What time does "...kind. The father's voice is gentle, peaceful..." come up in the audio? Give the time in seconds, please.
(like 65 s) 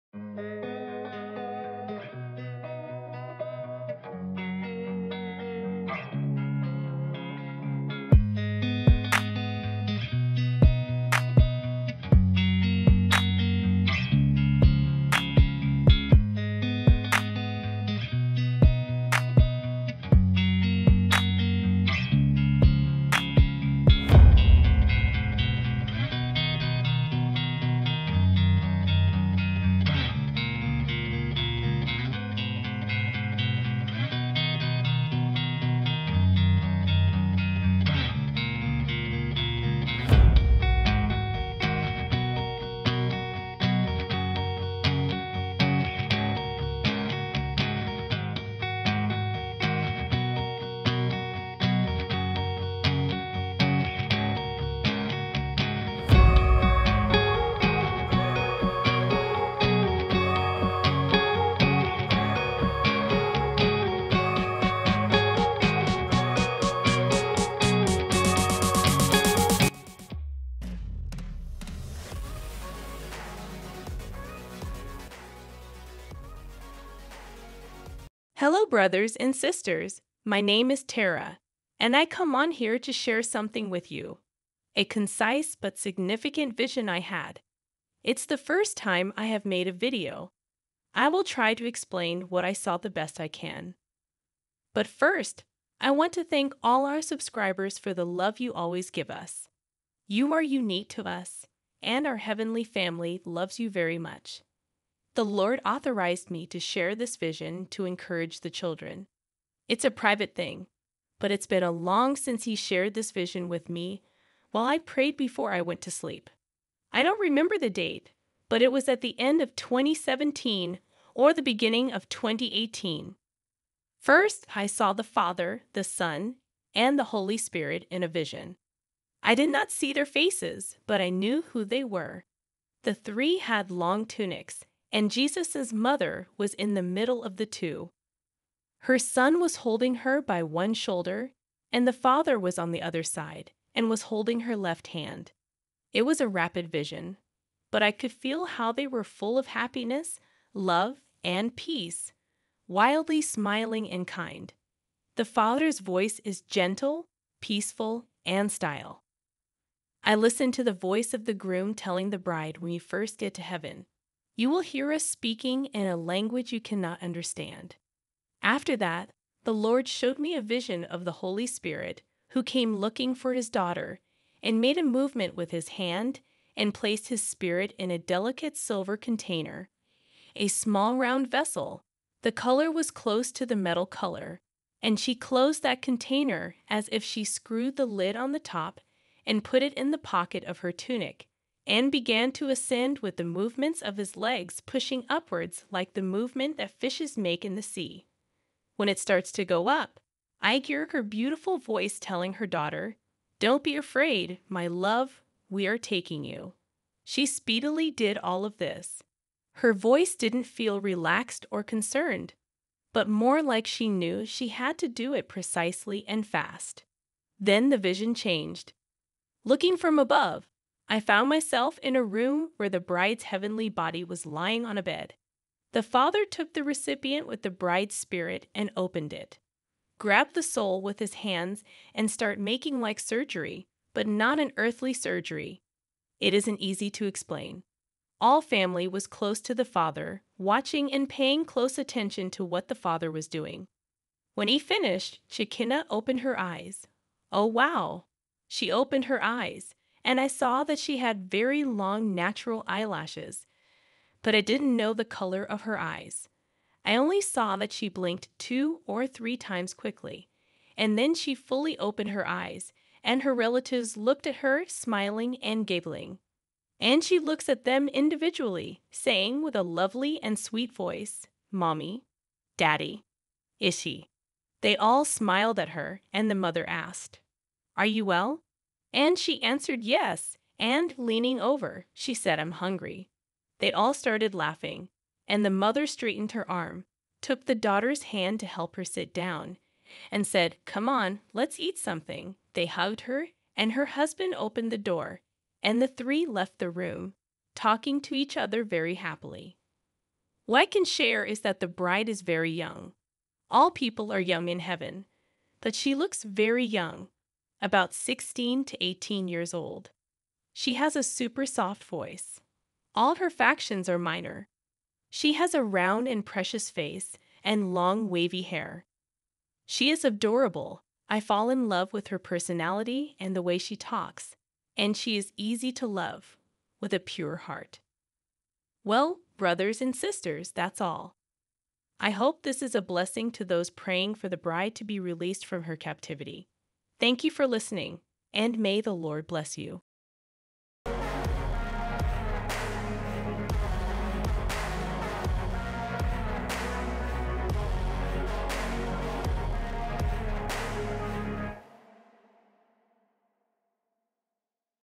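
154 s.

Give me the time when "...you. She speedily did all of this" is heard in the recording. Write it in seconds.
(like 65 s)
206 s.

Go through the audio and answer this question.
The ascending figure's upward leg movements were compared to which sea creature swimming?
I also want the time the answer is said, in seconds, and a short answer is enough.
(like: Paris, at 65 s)
fishes, at 196 s.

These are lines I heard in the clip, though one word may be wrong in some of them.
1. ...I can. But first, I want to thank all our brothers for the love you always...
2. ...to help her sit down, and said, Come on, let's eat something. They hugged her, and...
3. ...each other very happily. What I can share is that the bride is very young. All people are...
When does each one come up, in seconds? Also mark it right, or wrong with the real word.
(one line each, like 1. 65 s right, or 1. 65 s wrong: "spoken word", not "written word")
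1. 93 s wrong: "subscribers", not "brothers"
2. 288 s right
3. 298 s right.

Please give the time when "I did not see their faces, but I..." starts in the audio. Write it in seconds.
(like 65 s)
129 s.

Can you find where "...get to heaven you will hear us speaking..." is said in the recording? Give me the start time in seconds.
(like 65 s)
163 s.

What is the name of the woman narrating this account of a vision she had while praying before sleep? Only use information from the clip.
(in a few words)
Tara.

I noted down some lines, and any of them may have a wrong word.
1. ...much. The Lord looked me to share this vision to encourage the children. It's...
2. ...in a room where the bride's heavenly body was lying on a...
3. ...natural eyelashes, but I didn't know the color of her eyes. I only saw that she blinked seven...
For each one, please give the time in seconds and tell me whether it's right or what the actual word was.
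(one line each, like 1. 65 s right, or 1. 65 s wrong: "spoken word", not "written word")
1. 103 s wrong: "authorized", not "looked"
2. 221 s right
3. 252 s wrong: "two", not "seven".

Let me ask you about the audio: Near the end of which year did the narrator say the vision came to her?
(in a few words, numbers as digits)
2017.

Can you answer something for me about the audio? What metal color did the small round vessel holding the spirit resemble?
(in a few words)
silver.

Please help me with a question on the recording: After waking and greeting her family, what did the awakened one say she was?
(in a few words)
hungry.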